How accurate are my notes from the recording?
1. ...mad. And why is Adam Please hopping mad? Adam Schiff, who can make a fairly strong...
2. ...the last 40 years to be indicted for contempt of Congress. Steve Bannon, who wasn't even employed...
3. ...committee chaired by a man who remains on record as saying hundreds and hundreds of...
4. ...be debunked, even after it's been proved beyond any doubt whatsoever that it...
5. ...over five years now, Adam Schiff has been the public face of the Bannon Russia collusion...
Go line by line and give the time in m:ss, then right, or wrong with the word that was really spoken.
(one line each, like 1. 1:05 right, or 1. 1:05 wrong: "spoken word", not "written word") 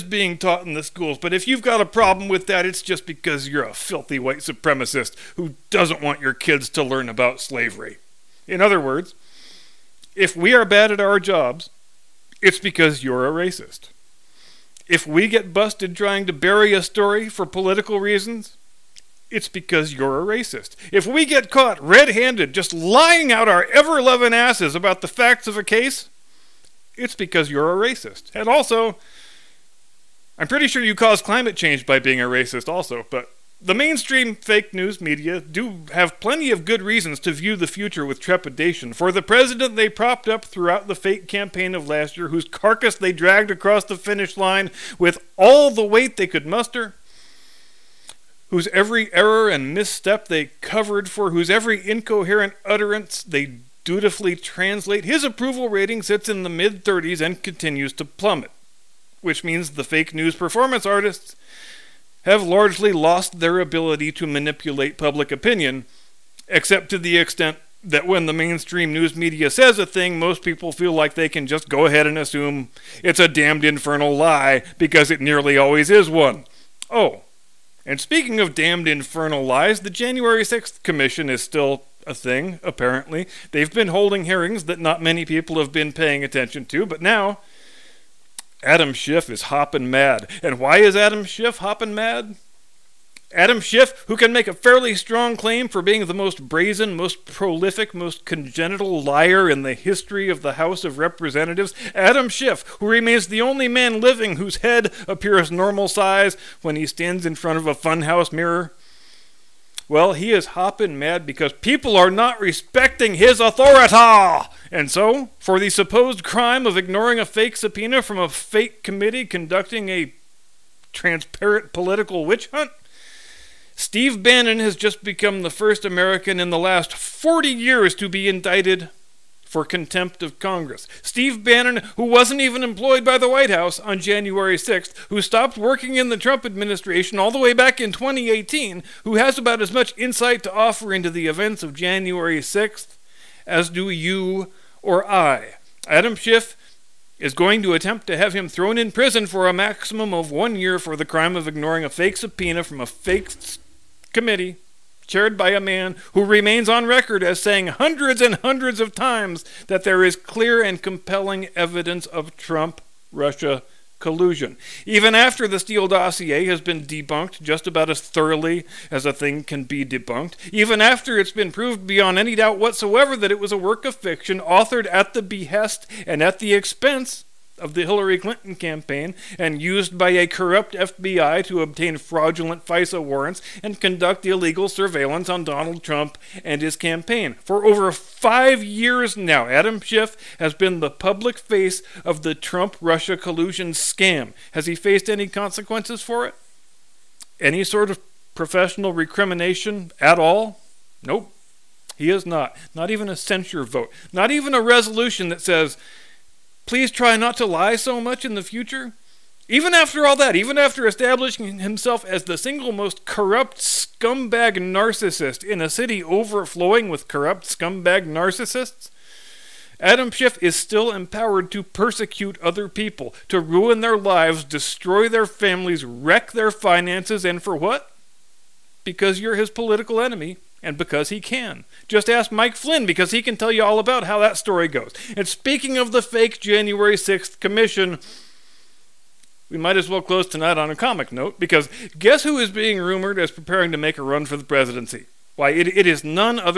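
1. 1:29 wrong: "Schiff", not "Please"
2. 2:06 right
3. 2:34 right
4. 2:49 right
5. 3:07 wrong: "Trump", not "Bannon".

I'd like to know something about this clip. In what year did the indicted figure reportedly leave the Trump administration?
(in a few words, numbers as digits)
2018.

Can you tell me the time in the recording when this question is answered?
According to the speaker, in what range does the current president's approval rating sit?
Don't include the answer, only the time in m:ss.
0:56.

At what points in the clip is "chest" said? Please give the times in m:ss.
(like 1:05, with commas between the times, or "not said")
not said.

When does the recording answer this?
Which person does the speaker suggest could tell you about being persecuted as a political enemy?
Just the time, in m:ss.
3:52.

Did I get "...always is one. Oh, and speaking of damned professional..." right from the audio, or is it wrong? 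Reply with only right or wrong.
wrong.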